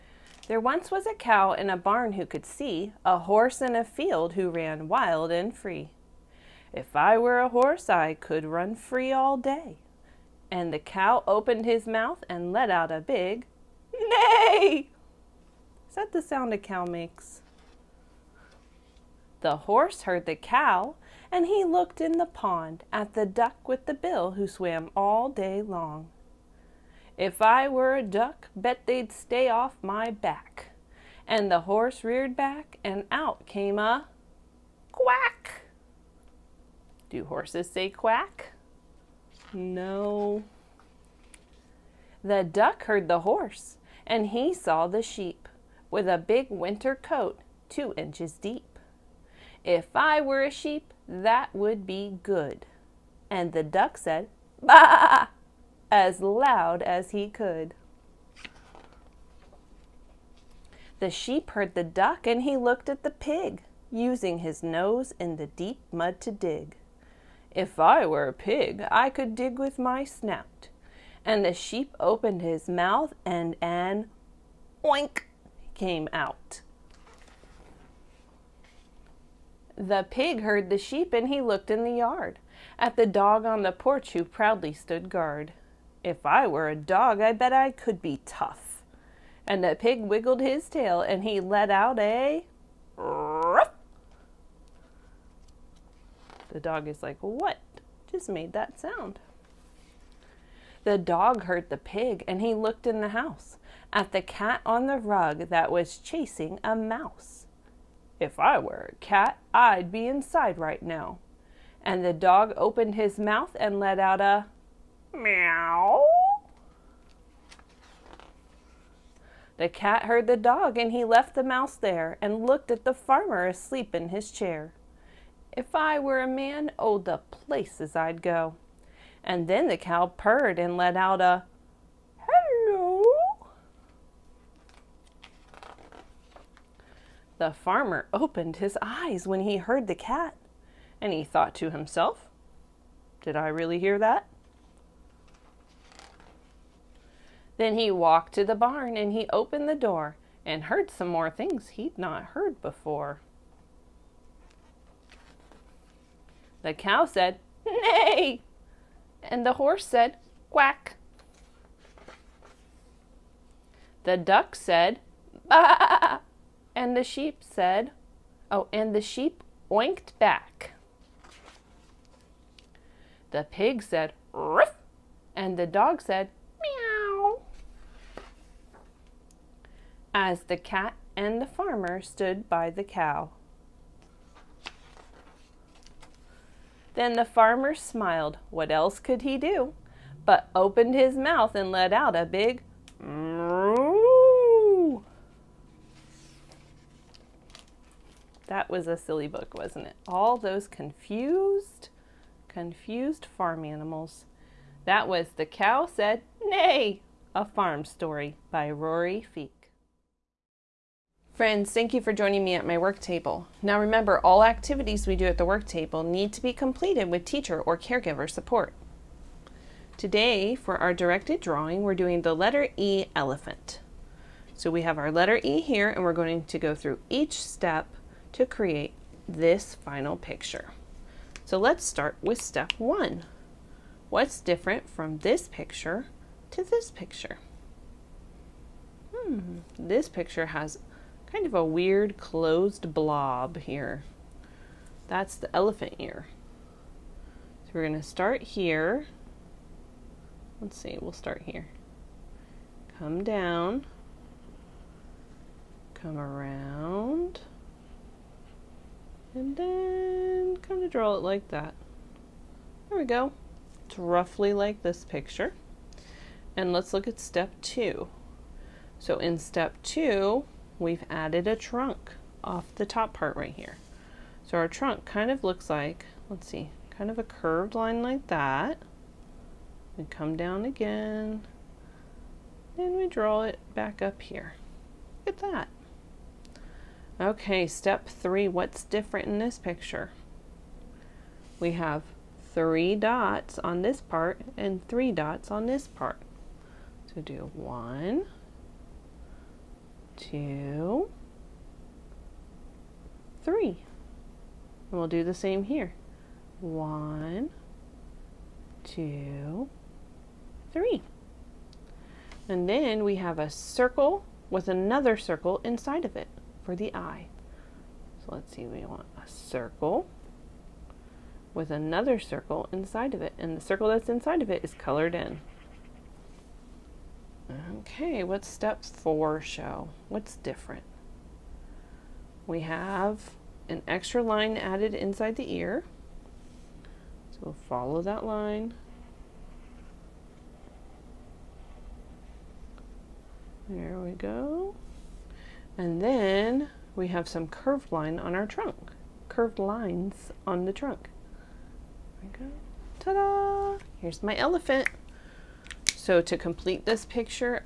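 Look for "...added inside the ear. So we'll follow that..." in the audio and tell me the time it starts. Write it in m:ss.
5:34.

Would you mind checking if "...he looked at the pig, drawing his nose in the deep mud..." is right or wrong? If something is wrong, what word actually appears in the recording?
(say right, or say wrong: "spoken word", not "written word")
wrong: "using", not "drawing".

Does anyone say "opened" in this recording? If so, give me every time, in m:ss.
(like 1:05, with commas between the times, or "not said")
0:11, 1:12, 1:52, 2:18, 2:29, 3:10.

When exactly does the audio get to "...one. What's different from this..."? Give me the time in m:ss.
3:52.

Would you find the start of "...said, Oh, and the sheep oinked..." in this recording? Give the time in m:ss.
2:47.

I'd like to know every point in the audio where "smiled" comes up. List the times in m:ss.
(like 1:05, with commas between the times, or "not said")
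3:07.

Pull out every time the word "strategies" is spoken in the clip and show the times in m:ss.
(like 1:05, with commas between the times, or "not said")
not said.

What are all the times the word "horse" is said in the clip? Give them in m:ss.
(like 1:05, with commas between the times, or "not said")
0:03, 0:07, 0:19, 0:31, 0:37, 0:43, 2:39.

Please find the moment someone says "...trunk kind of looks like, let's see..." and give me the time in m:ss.
4:34.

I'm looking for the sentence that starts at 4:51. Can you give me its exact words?
We have three dots on this part and three dots on this part.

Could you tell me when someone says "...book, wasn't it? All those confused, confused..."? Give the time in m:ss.
3:19.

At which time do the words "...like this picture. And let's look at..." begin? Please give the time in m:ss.
4:24.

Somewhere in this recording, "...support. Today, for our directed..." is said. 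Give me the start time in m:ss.
3:38.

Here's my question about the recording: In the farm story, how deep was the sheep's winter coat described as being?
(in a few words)
2 inches.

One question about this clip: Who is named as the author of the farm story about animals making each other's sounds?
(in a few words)
Rory Feek.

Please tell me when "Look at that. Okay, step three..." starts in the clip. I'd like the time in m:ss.
4:45.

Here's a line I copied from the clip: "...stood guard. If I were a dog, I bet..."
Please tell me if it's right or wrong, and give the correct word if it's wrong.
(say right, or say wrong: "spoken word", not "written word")
right.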